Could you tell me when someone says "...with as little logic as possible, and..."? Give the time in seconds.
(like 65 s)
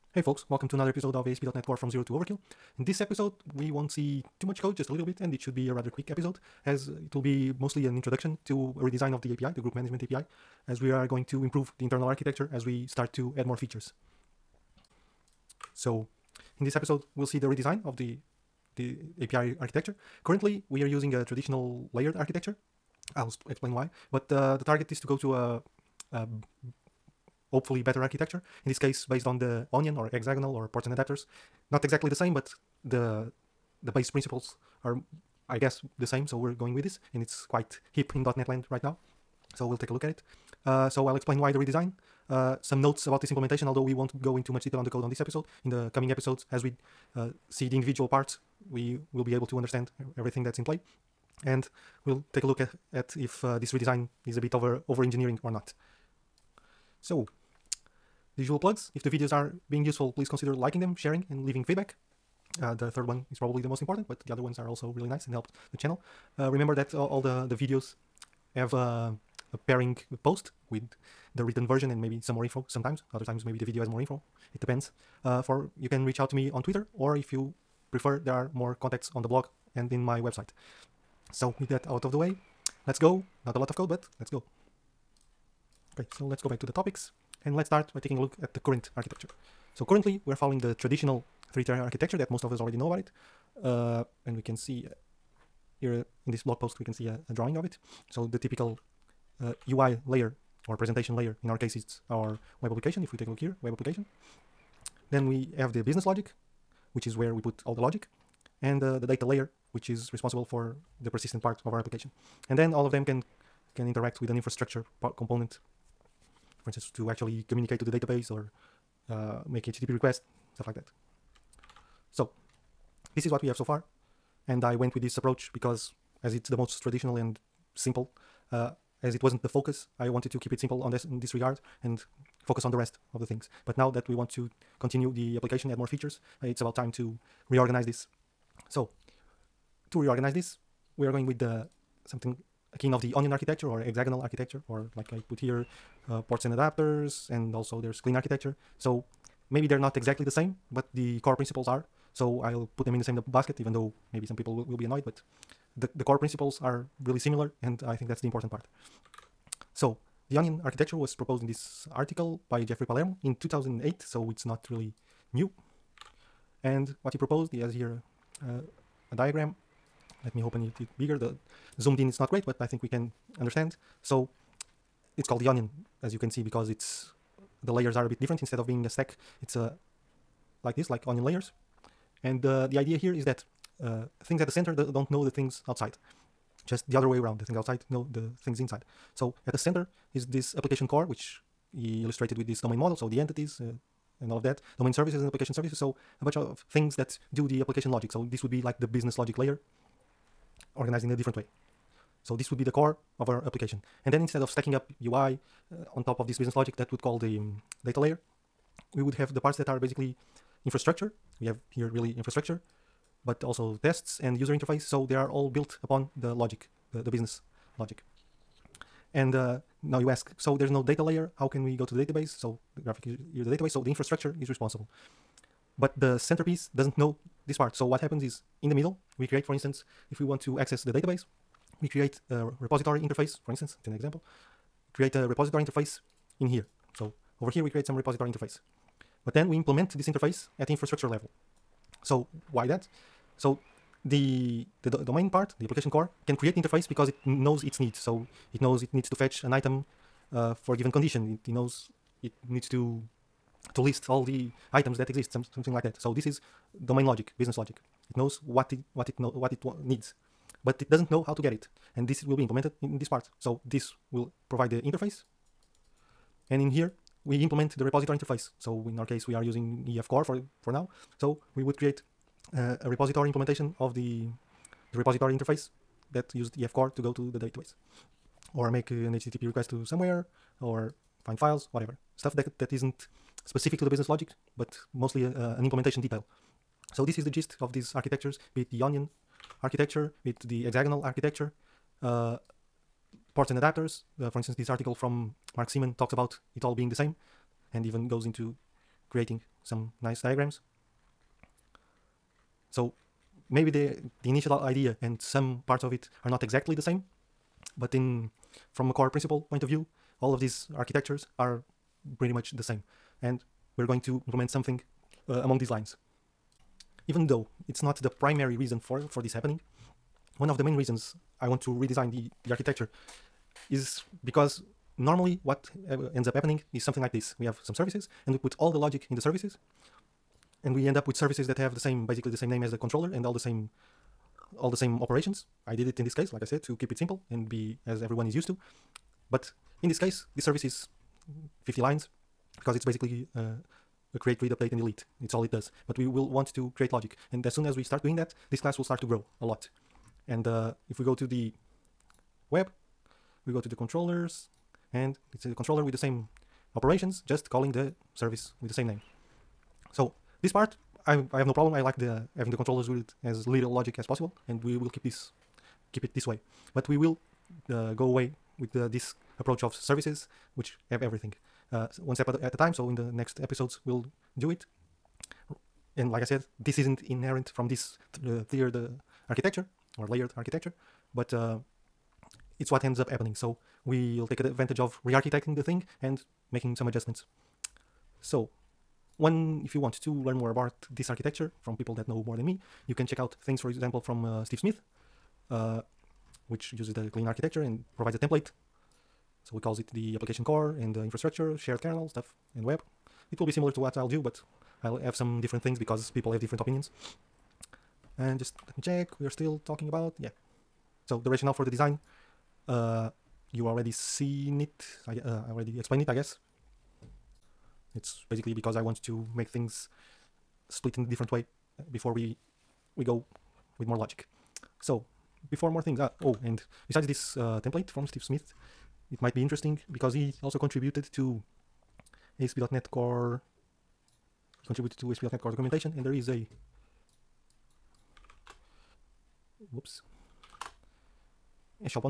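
362 s.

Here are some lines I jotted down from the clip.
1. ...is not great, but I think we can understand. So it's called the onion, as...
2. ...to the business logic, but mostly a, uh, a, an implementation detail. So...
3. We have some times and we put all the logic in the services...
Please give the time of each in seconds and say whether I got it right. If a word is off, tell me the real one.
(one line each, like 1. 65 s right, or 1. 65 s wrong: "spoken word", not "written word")
1. 172 s right
2. 283 s right
3. 327 s wrong: "services", not "times".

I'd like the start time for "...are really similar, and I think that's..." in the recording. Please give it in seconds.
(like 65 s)
156 s.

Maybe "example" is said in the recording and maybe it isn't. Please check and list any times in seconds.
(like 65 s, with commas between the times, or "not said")
233 s, 393 s.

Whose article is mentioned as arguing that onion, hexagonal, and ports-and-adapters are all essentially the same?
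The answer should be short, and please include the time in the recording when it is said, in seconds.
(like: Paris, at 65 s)
Mark Seemann, at 295 s.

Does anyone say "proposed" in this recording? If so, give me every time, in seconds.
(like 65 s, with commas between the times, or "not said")
161 s, 167 s.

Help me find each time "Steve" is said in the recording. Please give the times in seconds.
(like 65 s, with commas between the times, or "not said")
394 s, 428 s.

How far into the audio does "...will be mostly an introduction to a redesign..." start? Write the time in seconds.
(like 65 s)
7 s.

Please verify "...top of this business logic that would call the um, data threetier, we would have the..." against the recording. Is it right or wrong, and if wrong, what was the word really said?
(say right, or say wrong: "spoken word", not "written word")
wrong: "layer", not "threetier".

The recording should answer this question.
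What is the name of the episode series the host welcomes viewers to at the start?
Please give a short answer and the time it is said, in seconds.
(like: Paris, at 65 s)
ASP.NET Core from Zero to Overkill, at 1 s.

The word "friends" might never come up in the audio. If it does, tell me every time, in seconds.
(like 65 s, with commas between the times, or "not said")
not said.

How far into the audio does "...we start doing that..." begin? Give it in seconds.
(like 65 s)
347 s.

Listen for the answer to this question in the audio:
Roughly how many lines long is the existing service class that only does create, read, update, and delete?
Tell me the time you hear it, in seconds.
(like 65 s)
341 s.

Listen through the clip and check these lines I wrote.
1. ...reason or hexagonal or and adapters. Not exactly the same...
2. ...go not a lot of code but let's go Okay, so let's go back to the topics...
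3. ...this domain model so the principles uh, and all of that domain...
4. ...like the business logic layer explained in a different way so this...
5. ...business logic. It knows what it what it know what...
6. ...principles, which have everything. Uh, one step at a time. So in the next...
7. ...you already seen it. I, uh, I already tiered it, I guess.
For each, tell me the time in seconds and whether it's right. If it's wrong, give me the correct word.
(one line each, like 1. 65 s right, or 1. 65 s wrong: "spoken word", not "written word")
1. 29 s wrong: "onion", not "reason"
2. 82 s right
3. 192 s wrong: "entities", not "principles"
4. 198 s wrong: "organized", not "explained"
5. 257 s right
6. 369 s wrong: "services", not "principles"
7. 413 s wrong: "explained", not "tiered".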